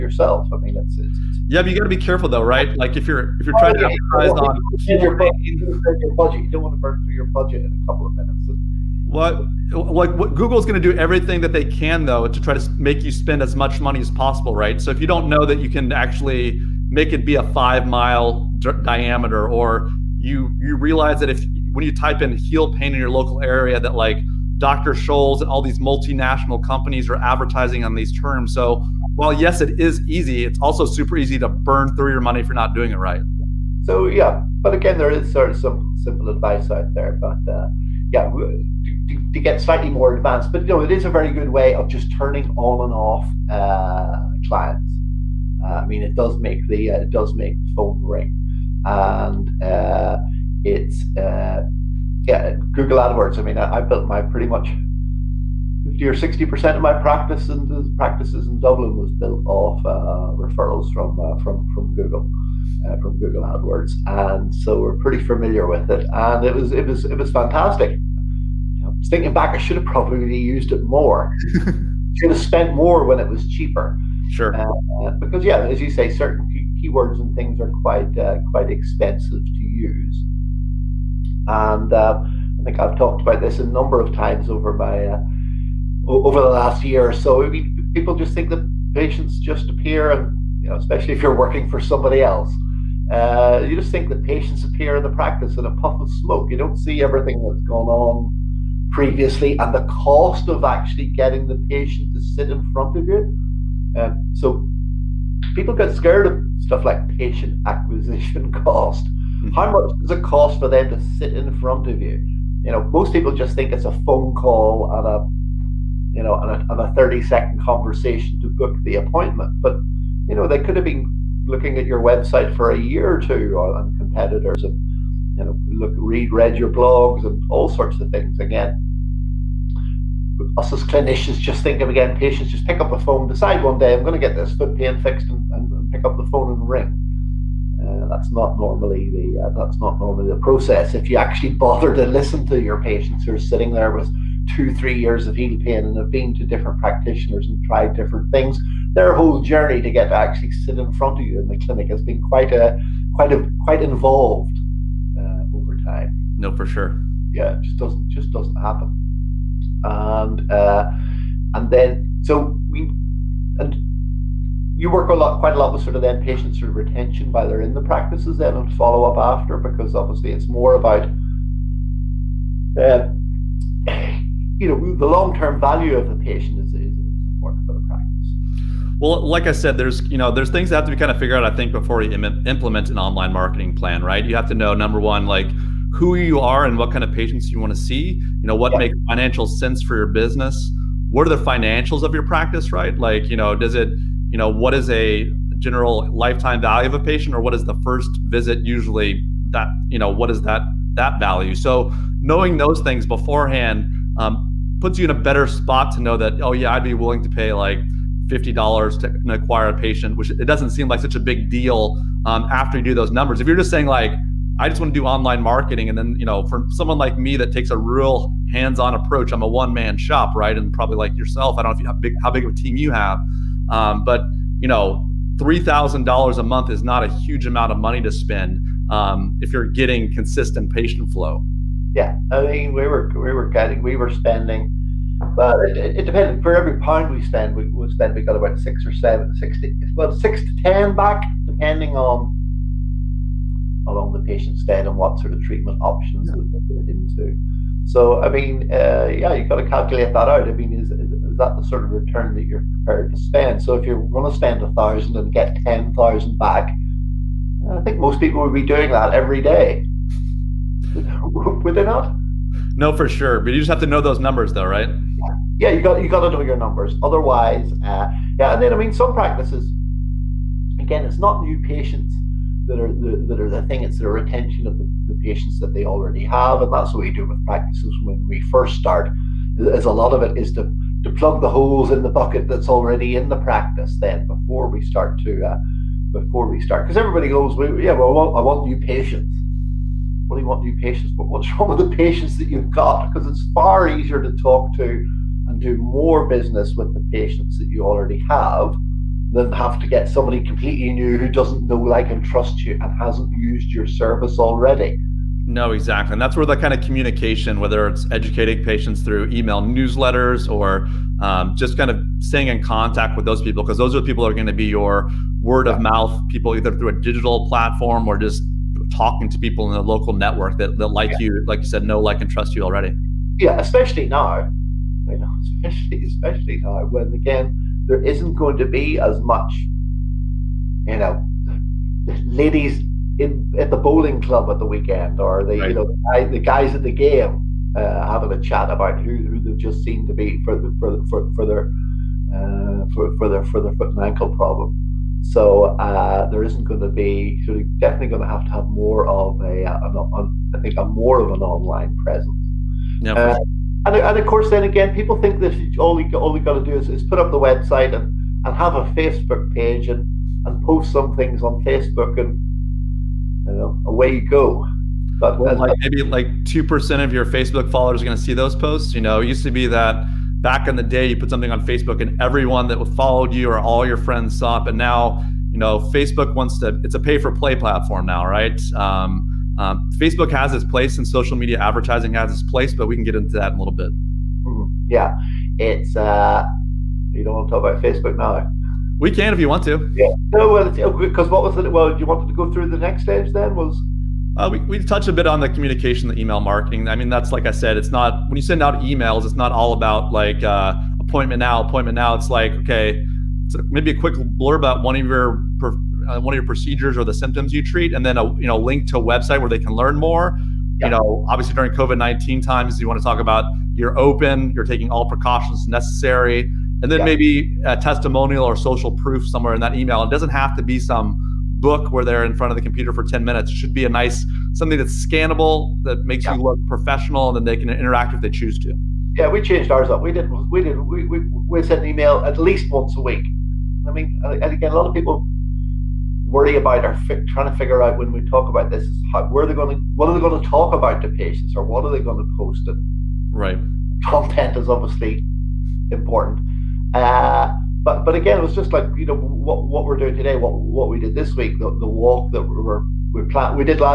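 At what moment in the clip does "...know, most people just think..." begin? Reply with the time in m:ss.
1:52.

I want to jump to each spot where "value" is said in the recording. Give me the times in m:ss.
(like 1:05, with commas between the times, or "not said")
2:55, 3:16, 3:21.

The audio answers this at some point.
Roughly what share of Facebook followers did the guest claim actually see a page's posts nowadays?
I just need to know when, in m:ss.
6:06.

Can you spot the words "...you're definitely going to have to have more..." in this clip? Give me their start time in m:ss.
5:47.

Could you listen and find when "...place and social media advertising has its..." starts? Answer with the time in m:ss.
6:20.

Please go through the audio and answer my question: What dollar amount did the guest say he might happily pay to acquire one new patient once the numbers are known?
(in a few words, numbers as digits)
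$50.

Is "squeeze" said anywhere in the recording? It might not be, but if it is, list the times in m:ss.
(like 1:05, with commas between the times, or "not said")
not said.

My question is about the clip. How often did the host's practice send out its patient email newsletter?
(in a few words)
Once a week.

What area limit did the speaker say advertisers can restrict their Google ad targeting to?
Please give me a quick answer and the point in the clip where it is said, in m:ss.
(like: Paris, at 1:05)
5 mile diameter, at 0:17.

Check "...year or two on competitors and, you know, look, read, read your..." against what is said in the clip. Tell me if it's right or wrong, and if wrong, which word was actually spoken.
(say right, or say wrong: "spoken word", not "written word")
right.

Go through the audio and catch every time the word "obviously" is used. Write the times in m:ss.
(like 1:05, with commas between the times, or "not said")
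2:49, 6:51, 7:24.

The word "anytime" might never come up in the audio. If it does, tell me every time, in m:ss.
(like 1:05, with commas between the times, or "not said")
not said.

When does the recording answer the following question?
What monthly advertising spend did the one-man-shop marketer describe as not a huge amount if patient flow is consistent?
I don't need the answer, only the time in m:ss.
3:45.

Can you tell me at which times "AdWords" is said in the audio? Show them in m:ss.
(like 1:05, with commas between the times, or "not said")
0:52, 1:03.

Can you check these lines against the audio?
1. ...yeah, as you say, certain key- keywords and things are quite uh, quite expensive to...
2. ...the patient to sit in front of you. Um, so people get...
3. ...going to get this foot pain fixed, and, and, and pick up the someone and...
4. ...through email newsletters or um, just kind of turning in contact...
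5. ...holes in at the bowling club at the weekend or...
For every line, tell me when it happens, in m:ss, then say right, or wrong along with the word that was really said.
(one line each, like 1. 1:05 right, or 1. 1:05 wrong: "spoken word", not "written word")
1. 1:15 right
2. 1:41 right
3. 2:14 wrong: "phone", not "someone"
4. 5:09 wrong: "staying", not "turning"
5. 5:32 wrong: "ladies", not "holes".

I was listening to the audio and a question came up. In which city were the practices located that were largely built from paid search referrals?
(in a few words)
Dublin.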